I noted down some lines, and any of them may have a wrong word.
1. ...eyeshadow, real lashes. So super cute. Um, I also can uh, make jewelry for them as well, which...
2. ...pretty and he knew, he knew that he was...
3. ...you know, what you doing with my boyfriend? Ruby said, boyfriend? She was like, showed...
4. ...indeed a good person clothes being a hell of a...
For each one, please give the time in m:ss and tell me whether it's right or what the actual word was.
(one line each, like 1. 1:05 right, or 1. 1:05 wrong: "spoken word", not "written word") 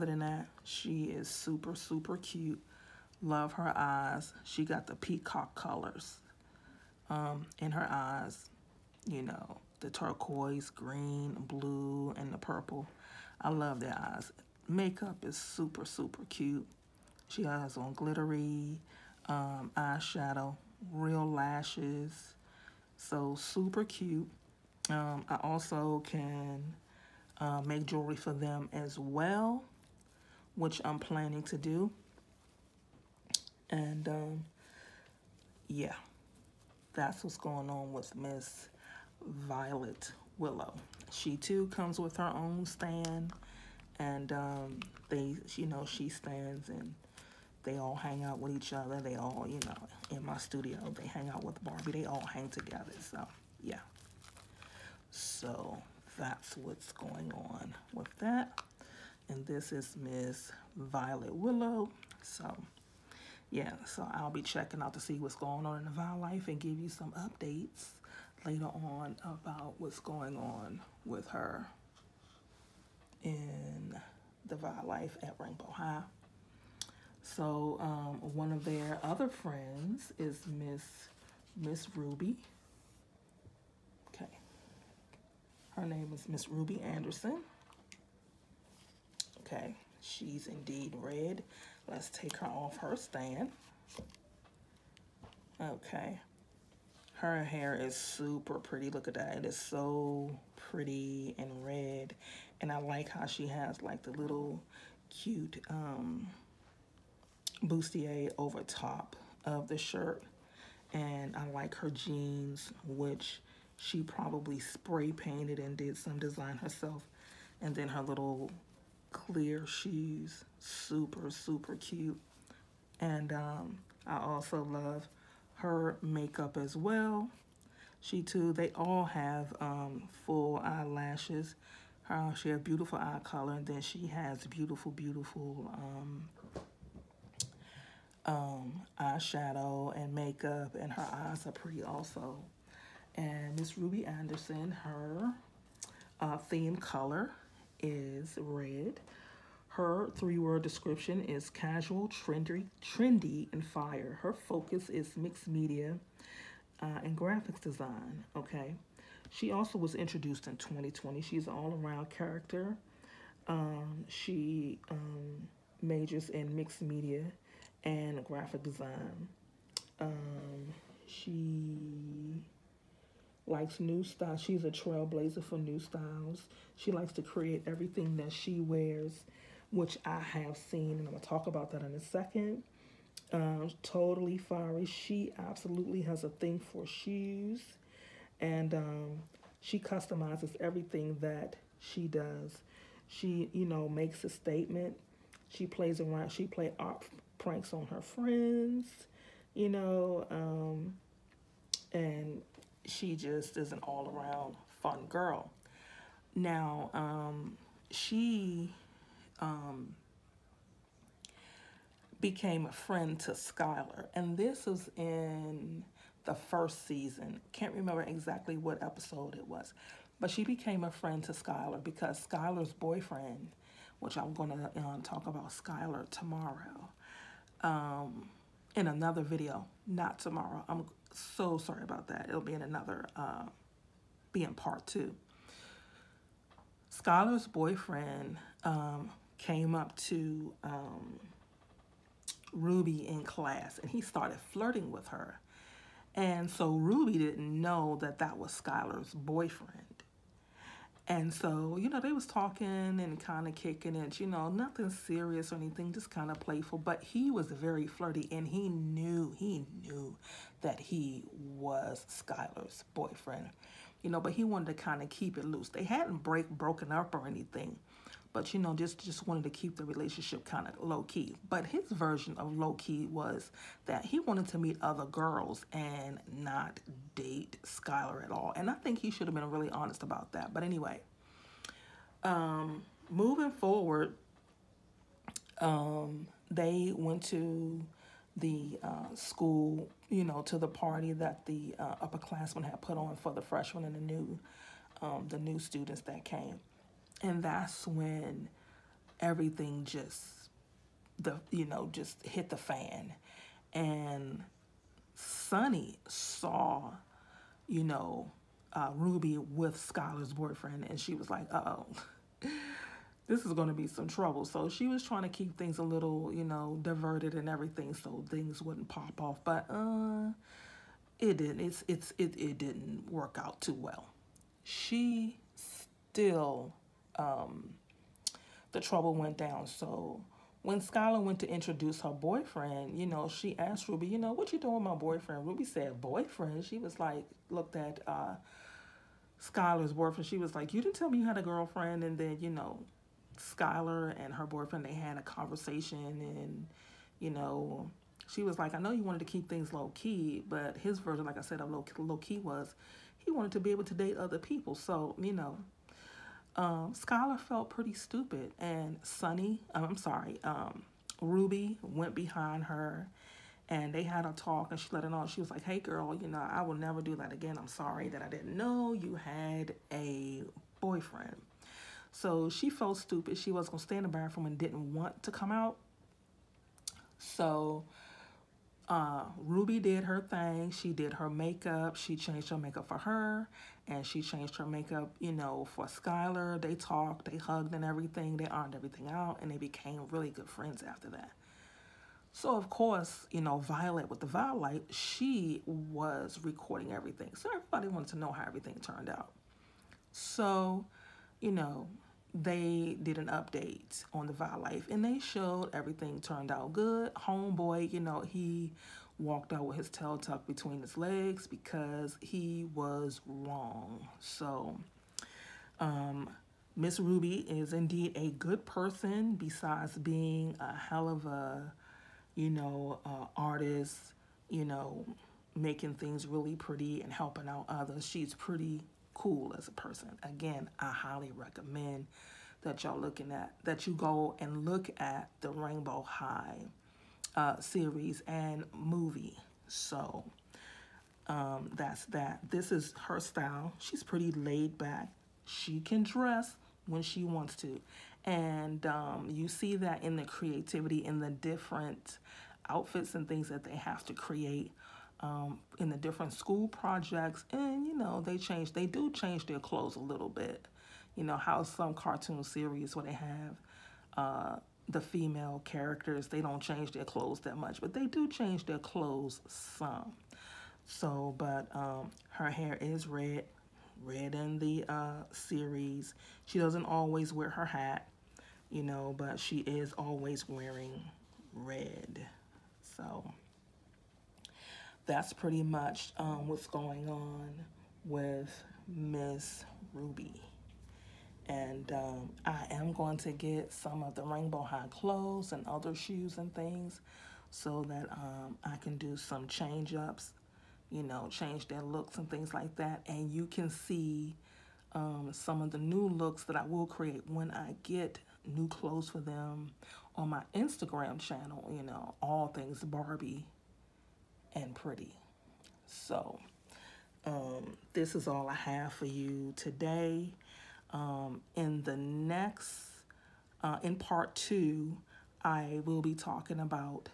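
1. 0:19 right
2. 4:17 wrong: "flirty", not "pretty"
3. 5:34 wrong: "looked", not "showed"
4. 6:57 wrong: "besides", not "clothes".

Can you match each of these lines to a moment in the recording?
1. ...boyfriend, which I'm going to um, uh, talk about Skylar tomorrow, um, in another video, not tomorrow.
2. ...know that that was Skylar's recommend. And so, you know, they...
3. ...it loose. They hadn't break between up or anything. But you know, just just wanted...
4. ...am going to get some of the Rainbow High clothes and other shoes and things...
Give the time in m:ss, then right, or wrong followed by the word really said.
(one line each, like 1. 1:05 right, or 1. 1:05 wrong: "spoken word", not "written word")
1. 3:42 right
2. 4:07 wrong: "boyfriend", not "recommend"
3. 4:25 wrong: "broken", not "between"
4. 8:12 right.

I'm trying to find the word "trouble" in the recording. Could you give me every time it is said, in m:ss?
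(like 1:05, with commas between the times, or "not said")
5:14, 5:28.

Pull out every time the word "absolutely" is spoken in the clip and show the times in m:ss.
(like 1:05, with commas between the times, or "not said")
3:05.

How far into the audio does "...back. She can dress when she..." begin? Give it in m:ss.
7:24.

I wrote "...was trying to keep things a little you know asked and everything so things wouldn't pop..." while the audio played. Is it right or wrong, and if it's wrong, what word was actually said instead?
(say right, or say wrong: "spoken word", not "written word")
wrong: "diverted", not "asked".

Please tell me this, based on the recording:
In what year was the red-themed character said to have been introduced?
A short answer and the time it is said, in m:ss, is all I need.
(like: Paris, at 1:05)
2020, at 2:40.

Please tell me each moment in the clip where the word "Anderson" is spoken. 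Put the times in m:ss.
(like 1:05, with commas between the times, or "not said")
1:26, 2:24.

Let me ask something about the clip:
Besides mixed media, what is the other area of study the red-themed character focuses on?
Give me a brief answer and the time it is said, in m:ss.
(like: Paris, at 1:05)
Graphic design, at 2:37.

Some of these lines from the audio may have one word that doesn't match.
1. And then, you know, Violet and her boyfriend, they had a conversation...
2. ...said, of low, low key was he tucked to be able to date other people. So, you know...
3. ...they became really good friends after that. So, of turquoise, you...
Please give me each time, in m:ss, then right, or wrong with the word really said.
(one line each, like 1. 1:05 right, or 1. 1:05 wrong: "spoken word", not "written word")
1. 5:42 wrong: "Skylar", not "Violet"
2. 5:51 wrong: "wanted", not "tucked"
3. 6:29 wrong: "course", not "turquoise".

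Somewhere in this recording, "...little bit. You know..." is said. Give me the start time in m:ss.
7:39.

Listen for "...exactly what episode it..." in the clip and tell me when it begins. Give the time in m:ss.
3:38.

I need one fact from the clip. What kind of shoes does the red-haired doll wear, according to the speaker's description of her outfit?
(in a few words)
Clear shoes.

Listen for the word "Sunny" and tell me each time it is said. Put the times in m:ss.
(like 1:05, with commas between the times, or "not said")
5:05, 5:59.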